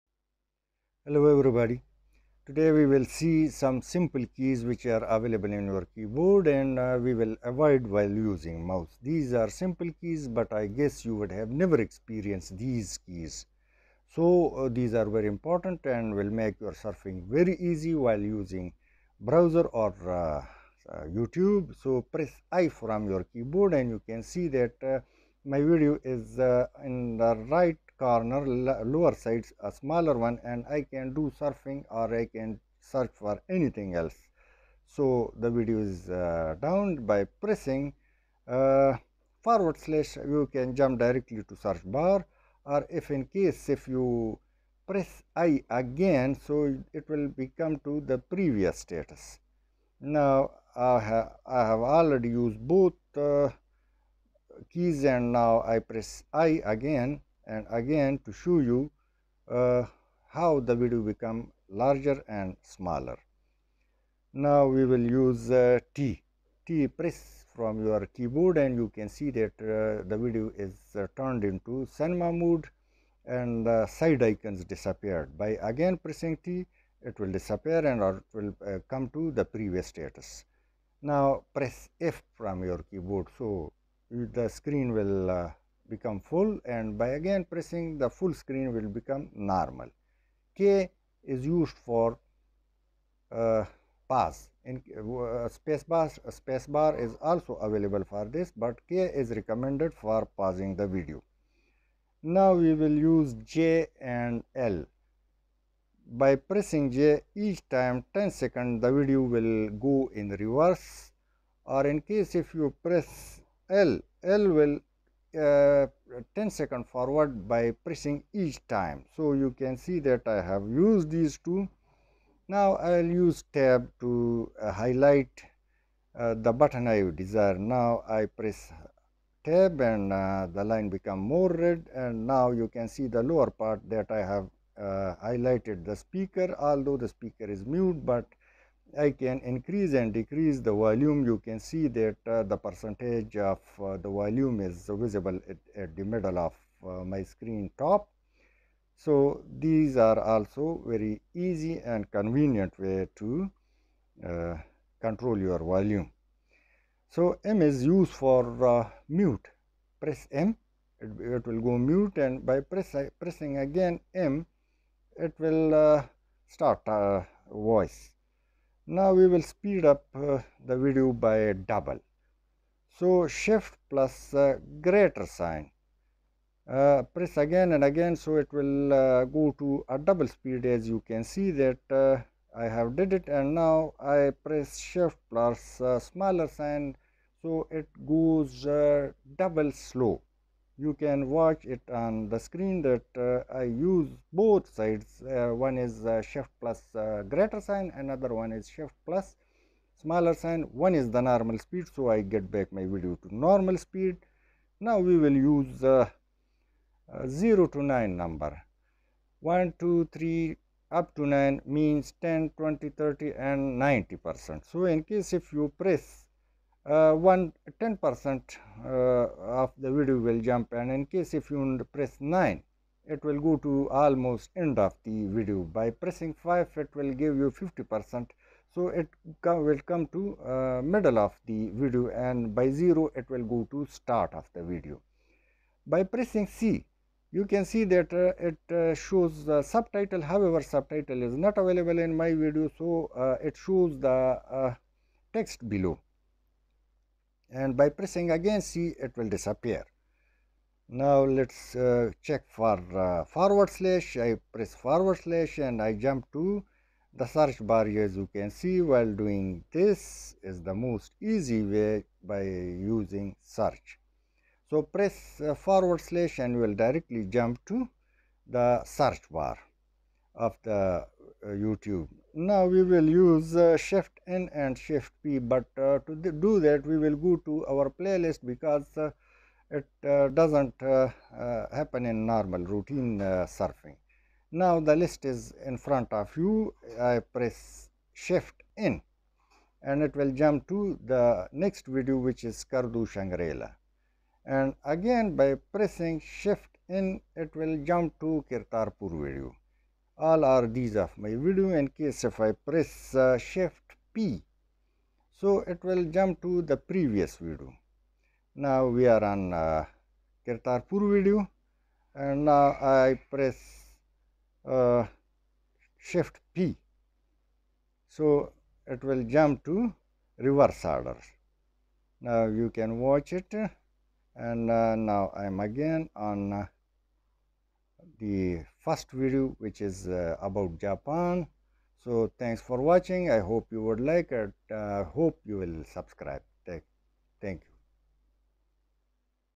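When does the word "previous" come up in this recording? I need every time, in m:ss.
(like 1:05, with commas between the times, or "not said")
0:48, 1:19, 5:06.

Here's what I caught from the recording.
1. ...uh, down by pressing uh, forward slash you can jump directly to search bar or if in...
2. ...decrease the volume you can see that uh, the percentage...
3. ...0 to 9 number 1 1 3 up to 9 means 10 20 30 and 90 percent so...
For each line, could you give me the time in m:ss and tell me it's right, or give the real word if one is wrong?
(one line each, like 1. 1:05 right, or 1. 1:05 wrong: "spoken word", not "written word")
1. 0:36 right
2. 2:20 right
3. 3:27 wrong: "2", not "1".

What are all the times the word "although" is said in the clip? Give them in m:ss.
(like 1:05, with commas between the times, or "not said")
2:16.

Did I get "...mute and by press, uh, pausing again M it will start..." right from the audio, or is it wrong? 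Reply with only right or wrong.
wrong.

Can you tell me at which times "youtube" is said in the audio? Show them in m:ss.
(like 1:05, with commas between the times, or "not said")
0:21, 4:31.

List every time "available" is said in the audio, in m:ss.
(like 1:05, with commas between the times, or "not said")
0:05, 1:37, 4:01.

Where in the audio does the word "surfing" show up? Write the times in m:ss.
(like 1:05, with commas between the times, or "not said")
0:16, 0:31, 4:43.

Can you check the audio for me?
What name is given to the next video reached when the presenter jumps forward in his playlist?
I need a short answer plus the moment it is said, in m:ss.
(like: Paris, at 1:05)
Kardu shangri, at 4:52.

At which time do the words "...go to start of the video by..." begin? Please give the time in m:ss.
3:53.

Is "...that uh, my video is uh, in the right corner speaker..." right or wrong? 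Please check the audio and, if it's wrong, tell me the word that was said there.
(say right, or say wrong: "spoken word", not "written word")
wrong: "lower", not "speaker".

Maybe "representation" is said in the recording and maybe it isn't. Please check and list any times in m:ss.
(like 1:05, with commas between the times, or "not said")
not said.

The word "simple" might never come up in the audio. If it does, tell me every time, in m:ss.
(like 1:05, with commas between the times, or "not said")
0:03, 0:09.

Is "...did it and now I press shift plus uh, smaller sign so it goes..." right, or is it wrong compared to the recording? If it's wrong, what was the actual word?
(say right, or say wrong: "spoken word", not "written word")
right.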